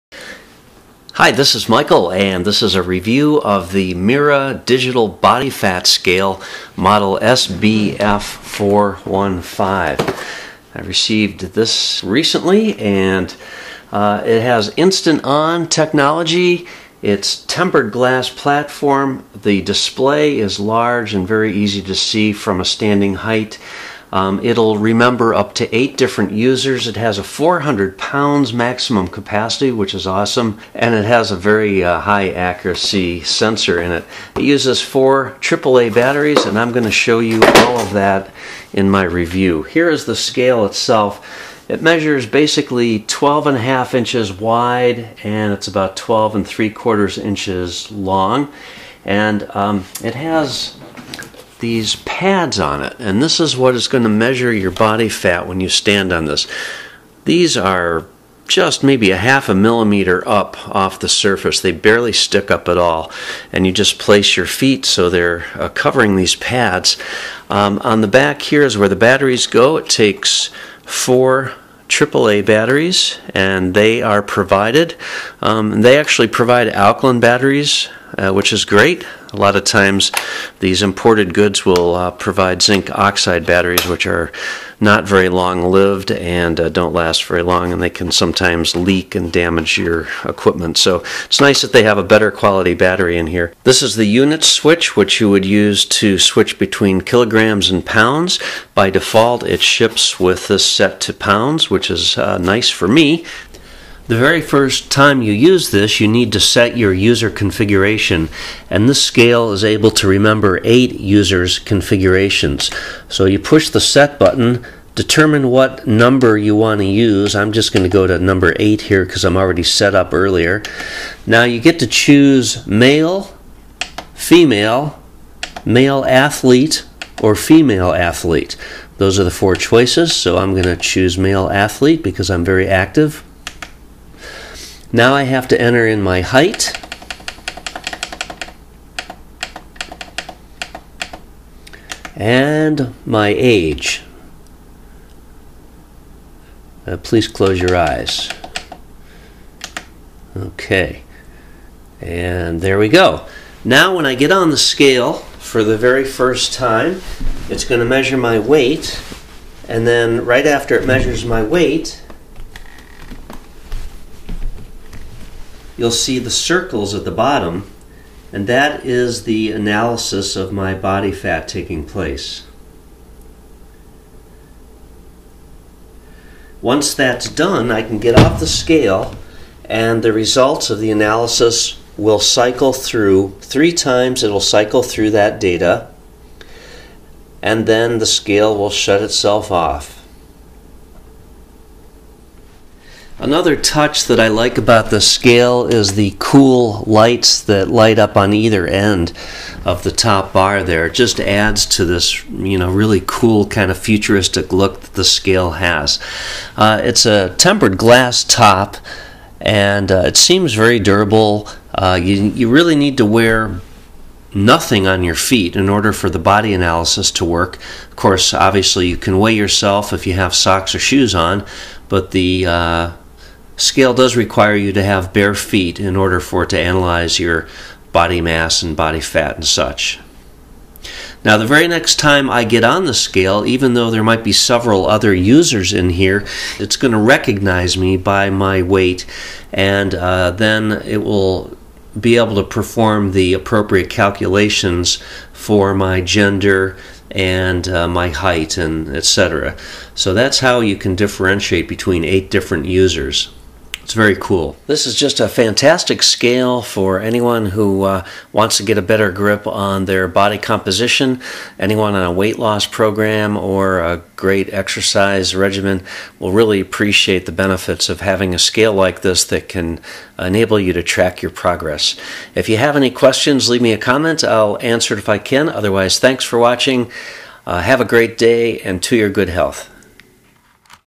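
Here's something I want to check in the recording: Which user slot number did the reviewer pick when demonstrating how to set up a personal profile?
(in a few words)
8.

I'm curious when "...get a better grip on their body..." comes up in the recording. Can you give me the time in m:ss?
4:18.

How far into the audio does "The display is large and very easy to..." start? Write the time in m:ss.
0:19.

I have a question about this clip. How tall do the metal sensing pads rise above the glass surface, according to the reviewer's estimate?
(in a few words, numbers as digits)
half a millimeter.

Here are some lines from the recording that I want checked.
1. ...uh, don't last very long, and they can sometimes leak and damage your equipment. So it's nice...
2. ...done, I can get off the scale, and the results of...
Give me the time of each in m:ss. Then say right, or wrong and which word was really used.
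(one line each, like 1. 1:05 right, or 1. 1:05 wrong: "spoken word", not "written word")
1. 1:26 right
2. 2:57 right.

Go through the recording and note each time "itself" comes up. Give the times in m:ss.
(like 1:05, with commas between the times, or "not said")
0:40, 3:09.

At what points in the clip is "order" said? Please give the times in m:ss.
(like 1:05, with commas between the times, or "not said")
3:35, 3:45.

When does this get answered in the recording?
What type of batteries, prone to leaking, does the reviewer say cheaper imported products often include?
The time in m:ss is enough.
1:22.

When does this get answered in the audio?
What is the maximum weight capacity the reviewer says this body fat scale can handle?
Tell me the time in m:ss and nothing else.
0:27.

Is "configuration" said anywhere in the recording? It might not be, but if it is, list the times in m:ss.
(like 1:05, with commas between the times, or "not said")
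1:47, 1:51.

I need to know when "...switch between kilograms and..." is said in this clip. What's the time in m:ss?
1:36.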